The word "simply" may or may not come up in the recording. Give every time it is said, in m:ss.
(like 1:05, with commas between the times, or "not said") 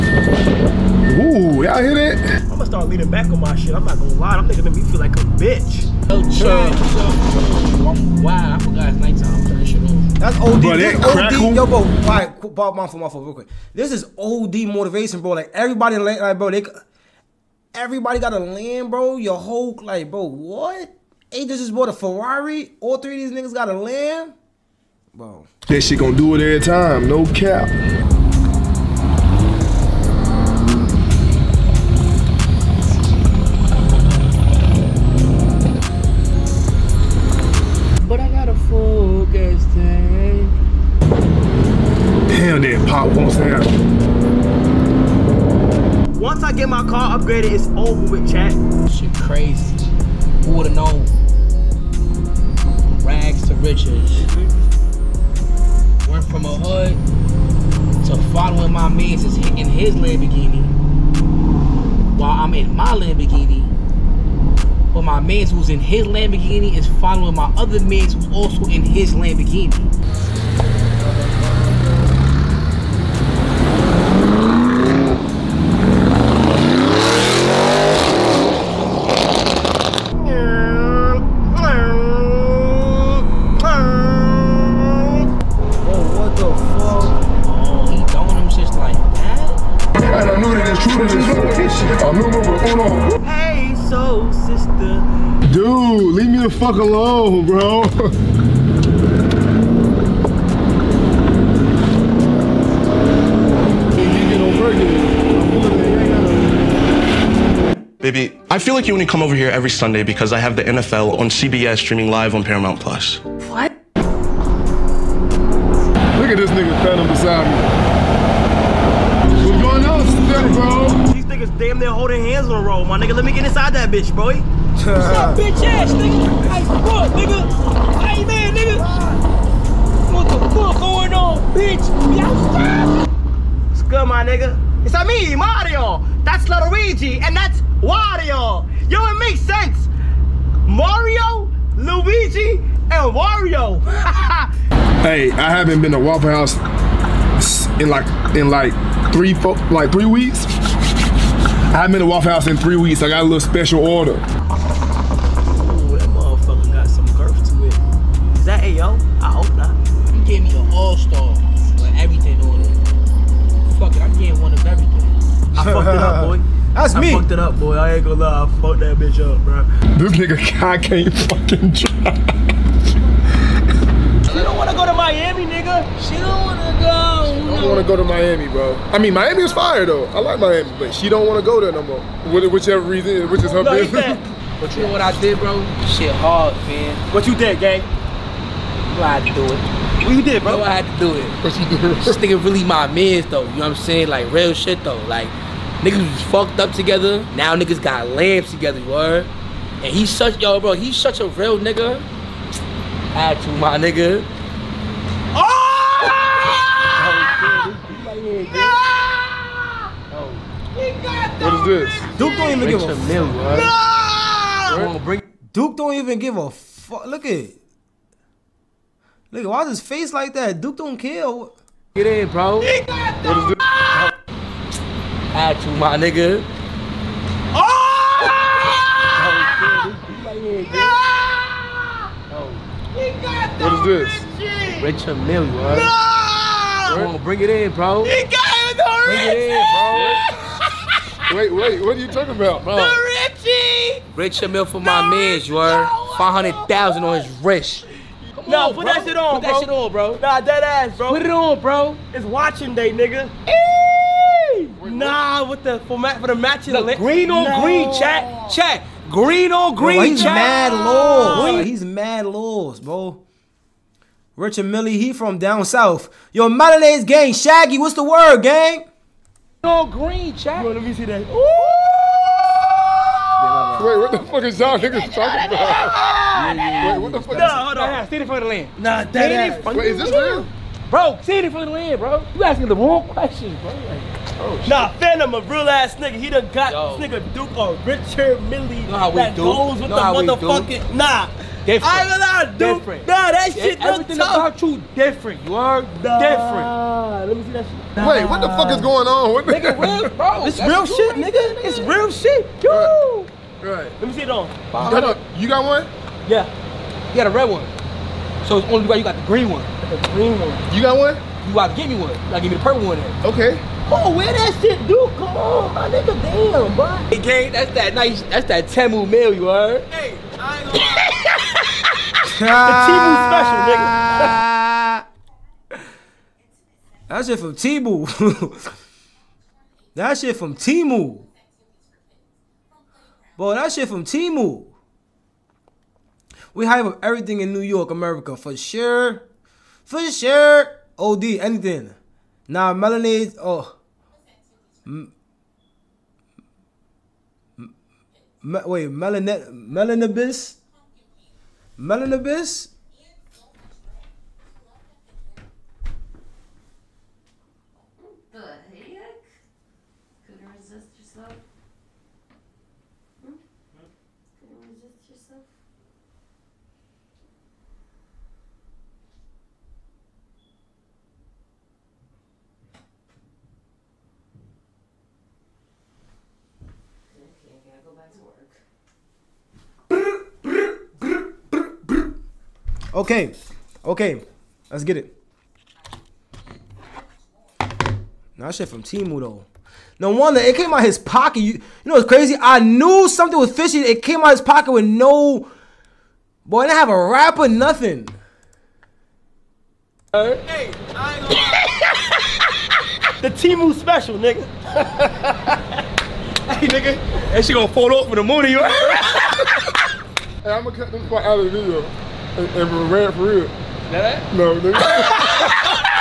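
not said.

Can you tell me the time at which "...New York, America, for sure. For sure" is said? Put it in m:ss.
5:37.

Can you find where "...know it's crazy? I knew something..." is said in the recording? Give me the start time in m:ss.
6:31.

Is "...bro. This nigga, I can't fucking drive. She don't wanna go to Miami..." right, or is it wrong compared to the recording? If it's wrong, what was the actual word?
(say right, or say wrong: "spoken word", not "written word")
right.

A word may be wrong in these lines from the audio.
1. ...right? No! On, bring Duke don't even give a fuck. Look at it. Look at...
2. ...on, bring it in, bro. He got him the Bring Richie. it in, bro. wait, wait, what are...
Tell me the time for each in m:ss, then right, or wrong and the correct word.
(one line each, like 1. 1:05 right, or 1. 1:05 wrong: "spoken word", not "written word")
1. 3:33 right
2. 3:57 right.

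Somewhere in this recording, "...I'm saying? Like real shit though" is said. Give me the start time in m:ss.
3:13.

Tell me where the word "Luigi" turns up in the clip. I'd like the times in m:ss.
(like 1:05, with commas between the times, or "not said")
2:16, 2:21.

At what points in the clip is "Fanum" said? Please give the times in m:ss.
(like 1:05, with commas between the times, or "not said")
4:44.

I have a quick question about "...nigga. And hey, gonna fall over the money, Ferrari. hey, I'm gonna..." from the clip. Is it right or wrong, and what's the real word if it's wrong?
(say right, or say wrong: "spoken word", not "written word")
wrong: "You", not "Ferrari".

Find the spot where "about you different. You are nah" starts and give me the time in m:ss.
4:54.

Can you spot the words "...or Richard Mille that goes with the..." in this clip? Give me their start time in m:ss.
4:47.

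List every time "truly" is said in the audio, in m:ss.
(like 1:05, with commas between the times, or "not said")
not said.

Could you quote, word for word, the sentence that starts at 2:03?
Let me get inside that bitch, boy.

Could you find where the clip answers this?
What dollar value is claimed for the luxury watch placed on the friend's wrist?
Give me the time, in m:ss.
4:05.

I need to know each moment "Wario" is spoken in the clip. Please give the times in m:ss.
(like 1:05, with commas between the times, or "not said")
2:17, 2:23.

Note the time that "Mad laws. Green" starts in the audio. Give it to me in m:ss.
4:20.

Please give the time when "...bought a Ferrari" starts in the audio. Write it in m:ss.
0:21.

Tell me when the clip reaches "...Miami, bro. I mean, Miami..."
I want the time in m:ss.
2:58.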